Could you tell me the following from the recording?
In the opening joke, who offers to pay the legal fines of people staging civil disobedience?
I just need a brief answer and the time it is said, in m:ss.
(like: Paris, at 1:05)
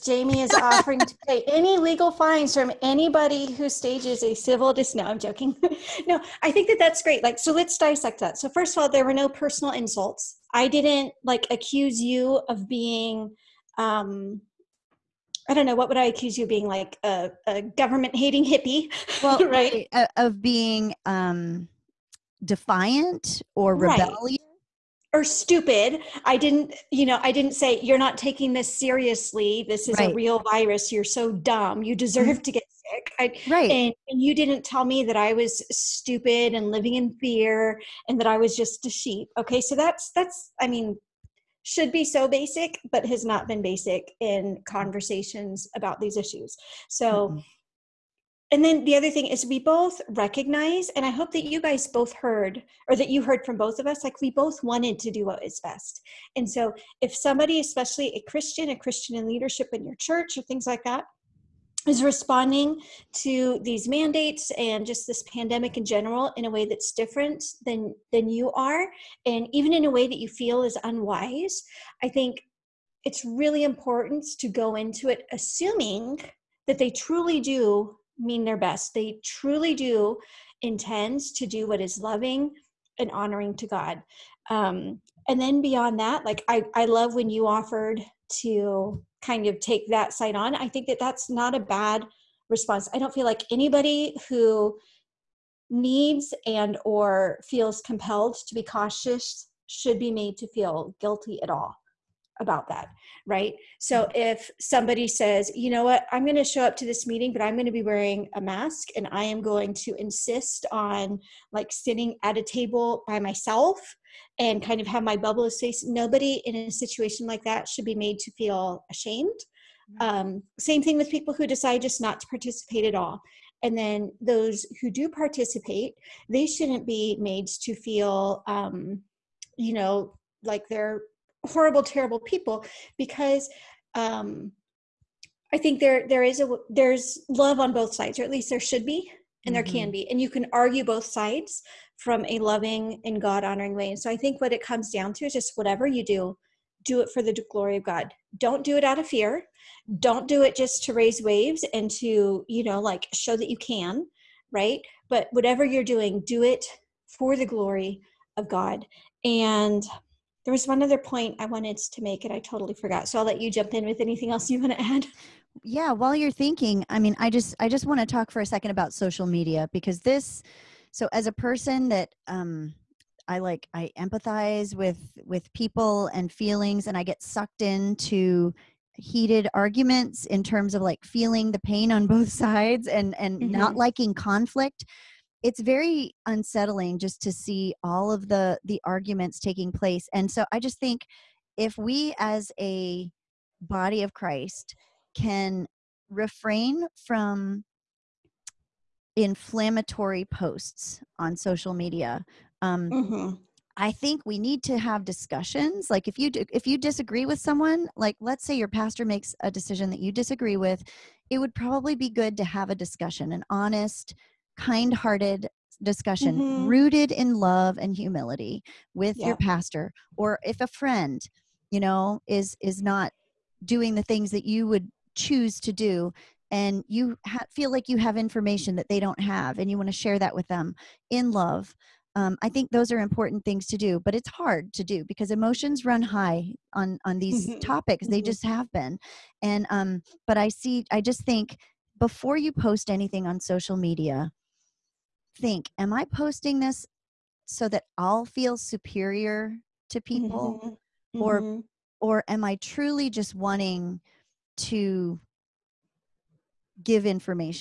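Jamie, at 0:00.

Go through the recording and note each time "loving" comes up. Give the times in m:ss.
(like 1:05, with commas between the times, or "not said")
1:21, 2:22.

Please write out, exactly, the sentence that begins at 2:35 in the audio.
But whatever you're doing, do it for the glory of God.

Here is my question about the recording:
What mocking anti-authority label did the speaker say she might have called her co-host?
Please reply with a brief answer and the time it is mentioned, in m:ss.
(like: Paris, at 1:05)
government hating hippie, at 0:17.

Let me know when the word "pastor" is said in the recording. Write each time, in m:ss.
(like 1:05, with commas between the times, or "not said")
3:28, 3:39.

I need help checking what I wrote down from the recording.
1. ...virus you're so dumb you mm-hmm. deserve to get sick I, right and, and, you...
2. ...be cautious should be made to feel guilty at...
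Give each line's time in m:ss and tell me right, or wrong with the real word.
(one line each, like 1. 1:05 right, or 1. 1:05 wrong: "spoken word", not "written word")
1. 0:30 right
2. 1:38 right.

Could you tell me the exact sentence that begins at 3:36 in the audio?
rooted in love and humility with yeah.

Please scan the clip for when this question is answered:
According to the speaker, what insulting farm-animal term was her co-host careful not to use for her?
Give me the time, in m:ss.
0:38.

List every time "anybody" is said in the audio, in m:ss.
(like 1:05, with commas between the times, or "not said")
0:02, 1:33.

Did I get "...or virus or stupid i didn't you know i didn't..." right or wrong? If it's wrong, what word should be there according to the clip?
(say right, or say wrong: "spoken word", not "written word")
wrong: "rebellious", not "virus".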